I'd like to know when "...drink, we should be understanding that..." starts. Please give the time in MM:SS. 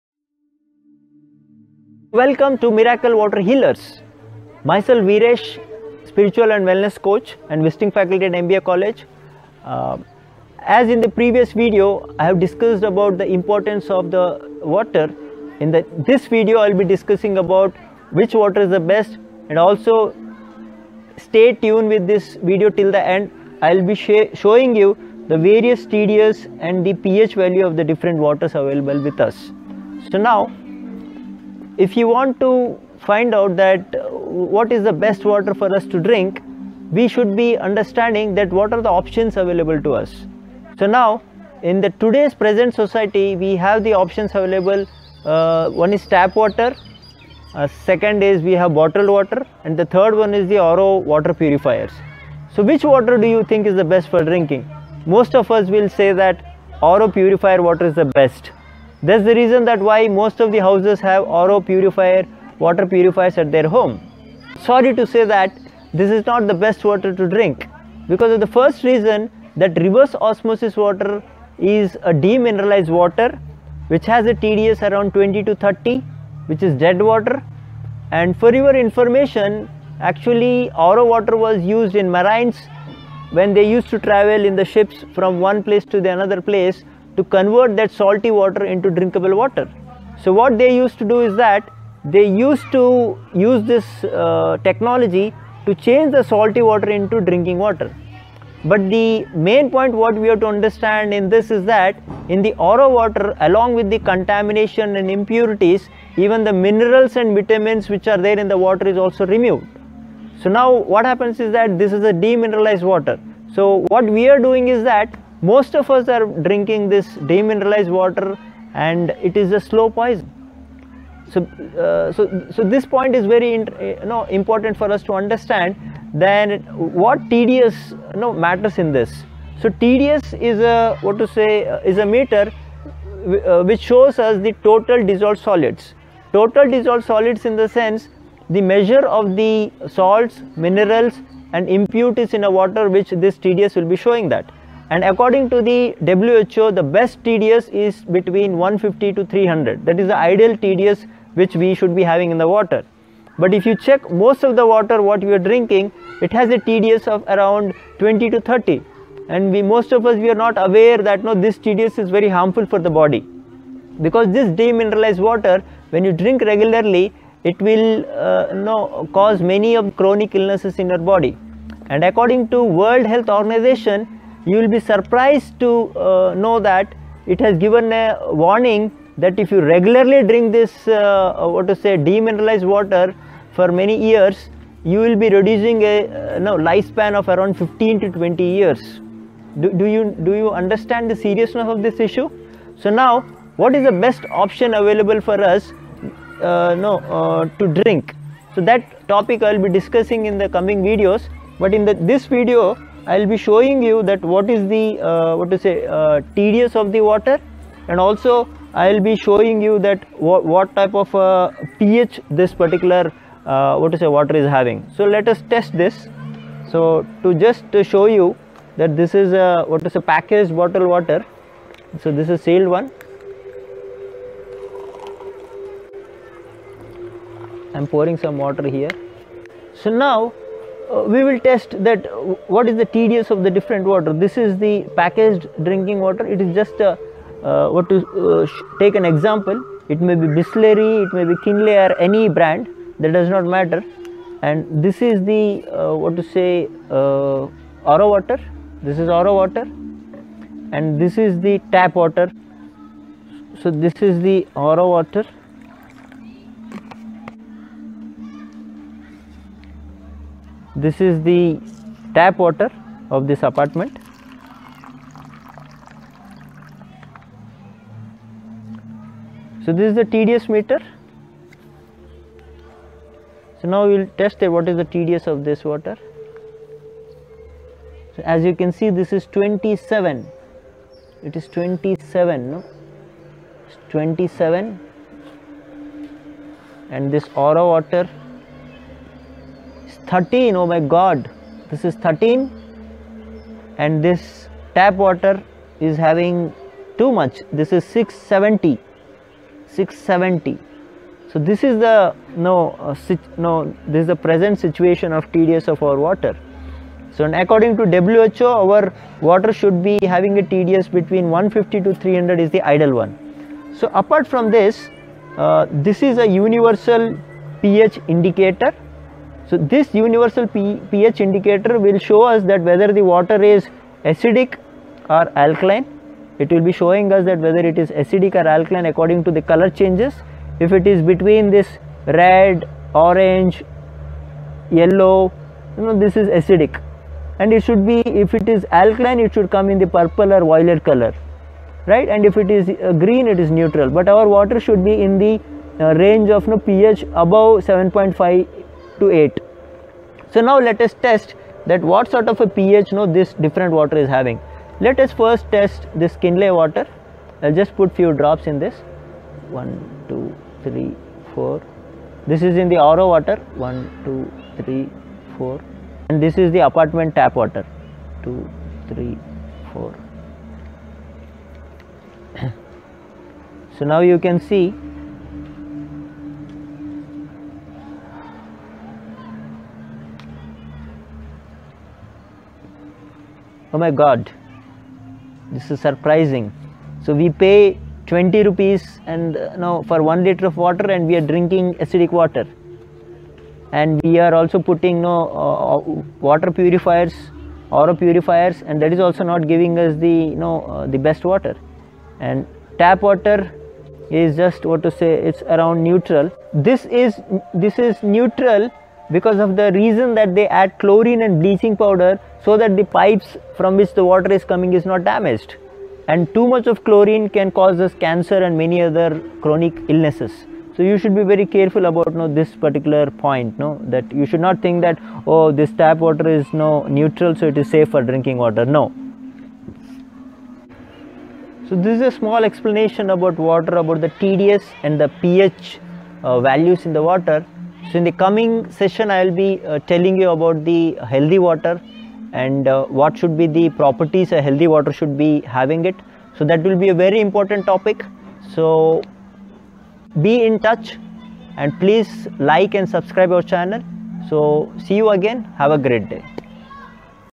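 00:35.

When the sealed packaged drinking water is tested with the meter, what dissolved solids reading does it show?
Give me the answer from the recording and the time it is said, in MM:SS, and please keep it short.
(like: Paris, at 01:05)
27, at 04:38.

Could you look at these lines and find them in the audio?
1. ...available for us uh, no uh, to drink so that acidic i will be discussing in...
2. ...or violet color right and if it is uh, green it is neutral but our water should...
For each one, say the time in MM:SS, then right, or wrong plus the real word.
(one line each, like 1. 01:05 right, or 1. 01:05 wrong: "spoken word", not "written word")
1. 03:14 wrong: "topic", not "acidic"
2. 05:40 right.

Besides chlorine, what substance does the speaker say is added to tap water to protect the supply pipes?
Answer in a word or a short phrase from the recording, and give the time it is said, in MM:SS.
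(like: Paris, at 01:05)
Bleaching powder, at 06:51.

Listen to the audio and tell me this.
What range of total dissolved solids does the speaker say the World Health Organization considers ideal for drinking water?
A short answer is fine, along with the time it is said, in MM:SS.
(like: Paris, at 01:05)
150 to 300, at 02:28.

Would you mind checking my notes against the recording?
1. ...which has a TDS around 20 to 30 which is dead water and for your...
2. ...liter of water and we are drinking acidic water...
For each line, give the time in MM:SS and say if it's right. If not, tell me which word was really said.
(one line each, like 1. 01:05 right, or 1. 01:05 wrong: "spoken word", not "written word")
1. 01:13 right
2. 06:30 right.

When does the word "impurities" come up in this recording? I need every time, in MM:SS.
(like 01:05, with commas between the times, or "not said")
01:45, 02:21.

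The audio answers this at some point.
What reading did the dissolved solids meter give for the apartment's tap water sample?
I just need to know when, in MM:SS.
04:57.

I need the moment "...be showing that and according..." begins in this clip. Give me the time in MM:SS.
02:23.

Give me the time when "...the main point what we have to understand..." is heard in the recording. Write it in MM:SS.
01:38.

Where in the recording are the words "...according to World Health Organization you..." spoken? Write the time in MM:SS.
02:52.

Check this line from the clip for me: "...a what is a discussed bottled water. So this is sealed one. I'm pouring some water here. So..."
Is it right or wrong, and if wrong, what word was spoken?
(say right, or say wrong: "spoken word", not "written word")
wrong: "packaged", not "discussed".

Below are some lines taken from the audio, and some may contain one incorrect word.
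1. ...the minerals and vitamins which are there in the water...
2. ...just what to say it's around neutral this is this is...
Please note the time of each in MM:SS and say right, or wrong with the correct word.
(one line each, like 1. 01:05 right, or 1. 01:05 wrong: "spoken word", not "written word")
1. 01:46 right
2. 06:44 right.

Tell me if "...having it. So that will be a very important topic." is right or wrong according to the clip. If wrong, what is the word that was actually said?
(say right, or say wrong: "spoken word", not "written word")
right.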